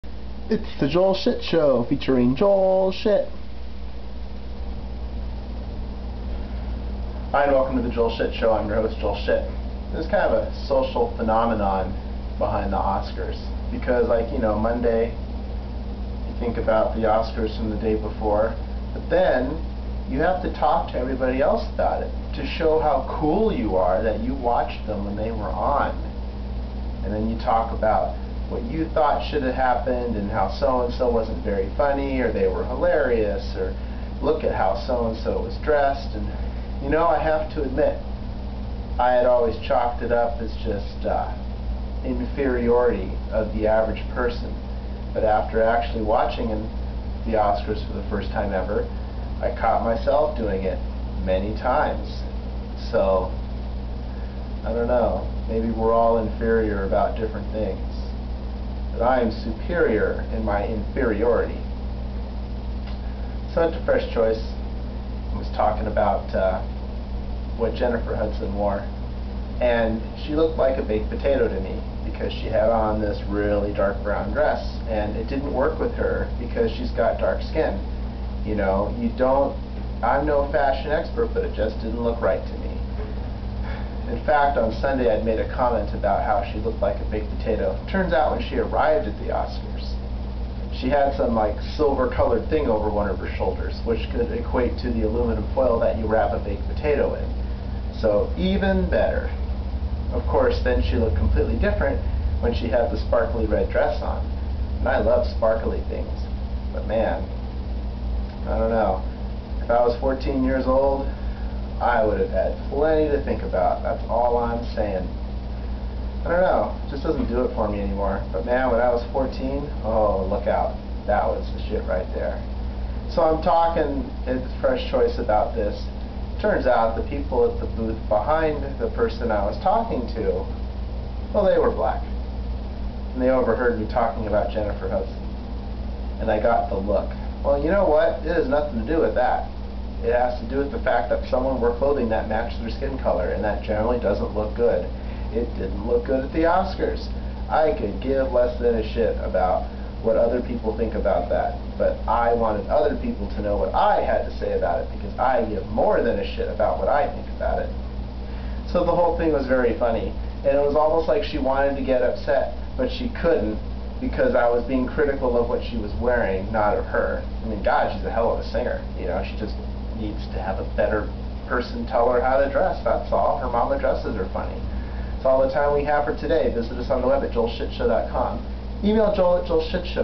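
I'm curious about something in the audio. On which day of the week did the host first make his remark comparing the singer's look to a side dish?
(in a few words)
Sunday.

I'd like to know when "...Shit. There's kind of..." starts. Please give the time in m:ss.
0:09.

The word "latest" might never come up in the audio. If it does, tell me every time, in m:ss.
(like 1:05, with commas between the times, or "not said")
not said.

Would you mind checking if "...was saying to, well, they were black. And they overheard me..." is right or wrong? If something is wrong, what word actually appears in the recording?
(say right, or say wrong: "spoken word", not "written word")
wrong: "talking", not "saying".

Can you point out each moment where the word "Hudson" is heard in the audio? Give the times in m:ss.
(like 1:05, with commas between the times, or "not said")
1:08, 2:14.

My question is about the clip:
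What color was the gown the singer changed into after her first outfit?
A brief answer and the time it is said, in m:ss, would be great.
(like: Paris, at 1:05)
Red, at 1:43.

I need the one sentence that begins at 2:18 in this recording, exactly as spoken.
It has nothing to do with that.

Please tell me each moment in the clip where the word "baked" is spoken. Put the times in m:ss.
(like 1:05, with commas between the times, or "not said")
1:10, 1:27, 1:36.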